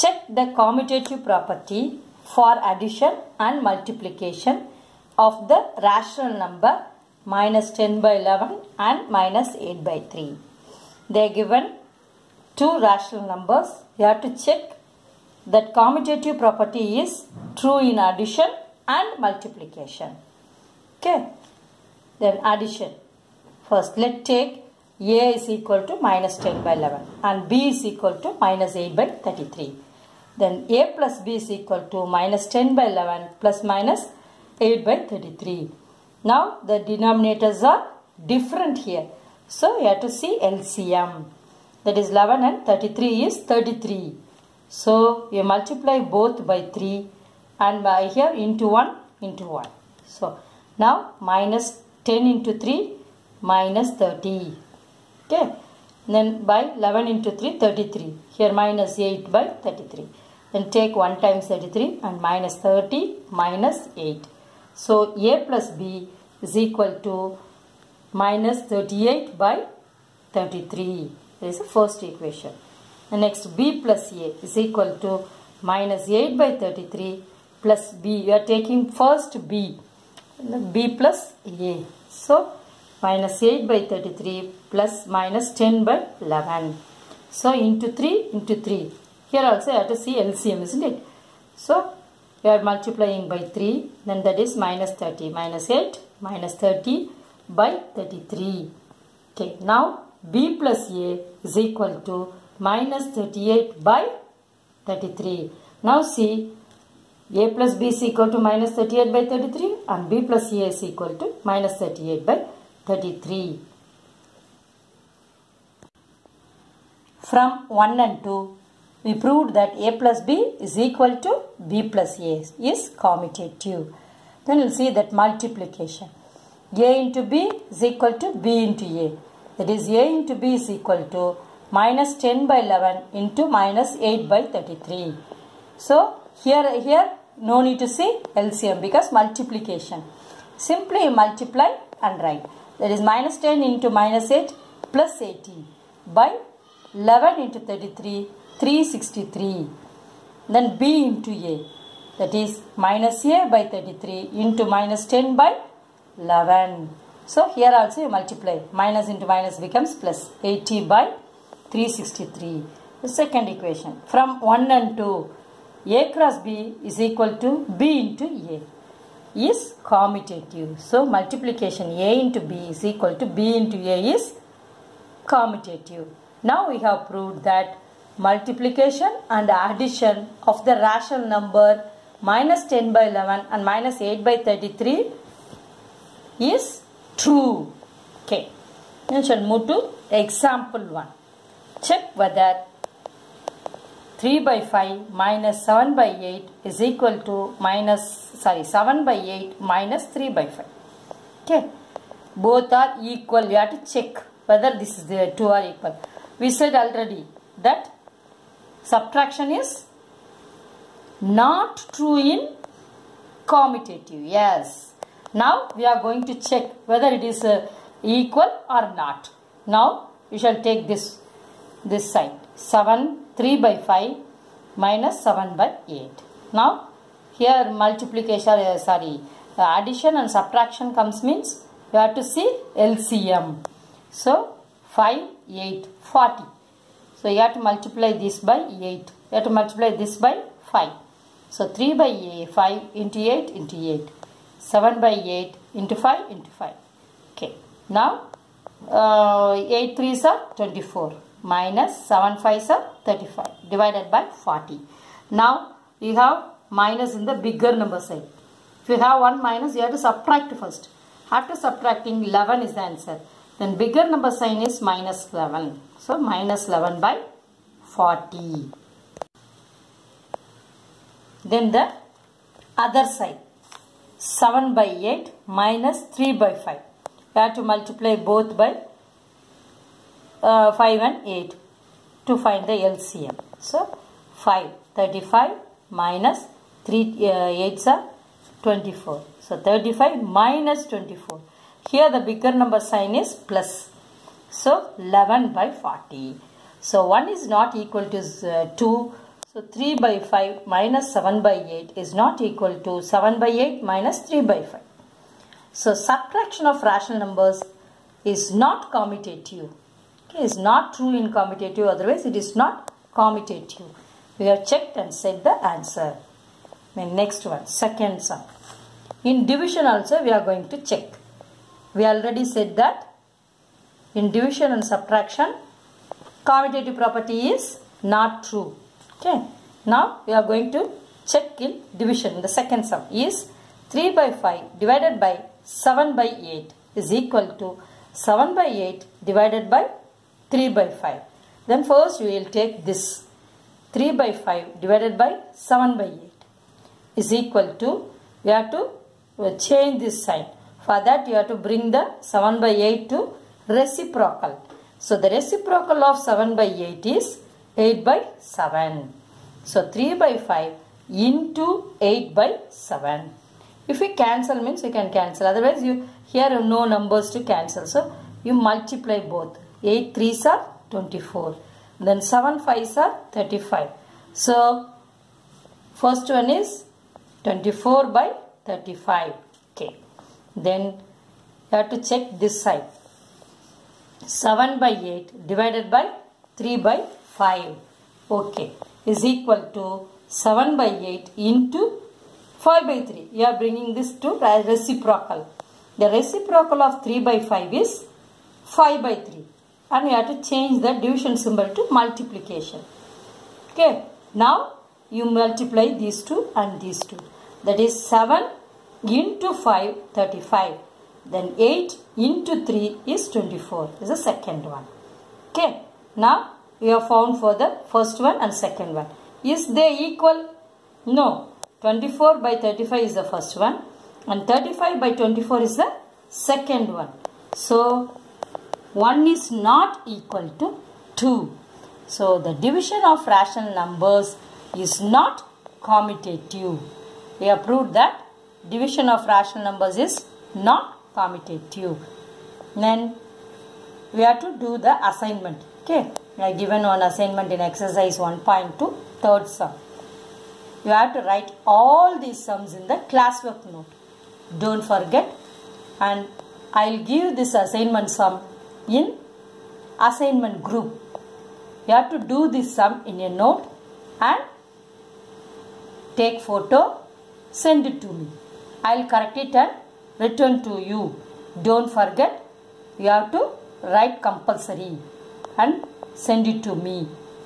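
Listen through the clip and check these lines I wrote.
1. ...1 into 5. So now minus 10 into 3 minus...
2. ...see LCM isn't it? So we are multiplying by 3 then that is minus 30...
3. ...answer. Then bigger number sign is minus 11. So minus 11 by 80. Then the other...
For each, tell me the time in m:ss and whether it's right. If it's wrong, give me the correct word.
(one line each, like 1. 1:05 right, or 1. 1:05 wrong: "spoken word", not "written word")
1. 0:48 wrong: "1", not "5"
2. 1:30 right
3. 4:22 wrong: "40", not "80".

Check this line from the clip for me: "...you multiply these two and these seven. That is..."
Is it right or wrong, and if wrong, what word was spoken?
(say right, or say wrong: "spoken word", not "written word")
wrong: "two", not "seven".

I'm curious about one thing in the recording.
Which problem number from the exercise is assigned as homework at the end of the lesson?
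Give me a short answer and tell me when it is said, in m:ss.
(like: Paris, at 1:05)
third, at 7:29.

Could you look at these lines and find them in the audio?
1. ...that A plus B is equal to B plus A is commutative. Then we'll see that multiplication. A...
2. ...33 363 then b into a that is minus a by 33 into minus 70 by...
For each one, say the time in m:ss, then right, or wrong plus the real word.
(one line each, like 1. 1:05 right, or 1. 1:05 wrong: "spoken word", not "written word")
1. 1:59 right
2. 2:27 wrong: "10", not "70".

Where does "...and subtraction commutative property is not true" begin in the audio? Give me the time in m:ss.
5:24.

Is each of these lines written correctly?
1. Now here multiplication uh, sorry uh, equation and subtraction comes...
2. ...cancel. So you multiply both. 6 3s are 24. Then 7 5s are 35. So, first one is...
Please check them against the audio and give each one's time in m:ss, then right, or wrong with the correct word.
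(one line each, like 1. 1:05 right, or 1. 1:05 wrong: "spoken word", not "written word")
1. 3:46 wrong: "addition", not "equation"
2. 6:07 wrong: "8", not "6".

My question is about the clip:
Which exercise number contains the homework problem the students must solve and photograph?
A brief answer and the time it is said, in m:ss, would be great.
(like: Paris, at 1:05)
1.2, at 7:27.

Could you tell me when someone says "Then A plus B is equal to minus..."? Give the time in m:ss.
0:30.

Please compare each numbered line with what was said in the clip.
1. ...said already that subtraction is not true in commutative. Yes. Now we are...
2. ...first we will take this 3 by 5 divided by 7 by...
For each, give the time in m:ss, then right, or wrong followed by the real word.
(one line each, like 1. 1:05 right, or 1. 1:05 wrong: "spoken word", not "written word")
1. 3:26 right
2. 5:41 right.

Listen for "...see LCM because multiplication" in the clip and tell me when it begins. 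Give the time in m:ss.
2:17.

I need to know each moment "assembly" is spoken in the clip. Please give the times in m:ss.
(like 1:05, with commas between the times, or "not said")
not said.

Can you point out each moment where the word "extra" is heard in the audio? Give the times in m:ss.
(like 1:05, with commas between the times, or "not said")
not said.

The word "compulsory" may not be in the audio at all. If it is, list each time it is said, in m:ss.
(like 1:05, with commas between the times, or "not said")
7:54.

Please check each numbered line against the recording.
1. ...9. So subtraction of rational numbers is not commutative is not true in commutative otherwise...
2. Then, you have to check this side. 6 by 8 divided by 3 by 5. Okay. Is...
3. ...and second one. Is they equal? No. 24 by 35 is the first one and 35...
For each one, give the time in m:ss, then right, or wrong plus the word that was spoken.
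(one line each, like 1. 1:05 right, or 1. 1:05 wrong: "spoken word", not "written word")
1. 5:04 wrong: "5", not "9"
2. 6:20 wrong: "7", not "6"
3. 6:58 right.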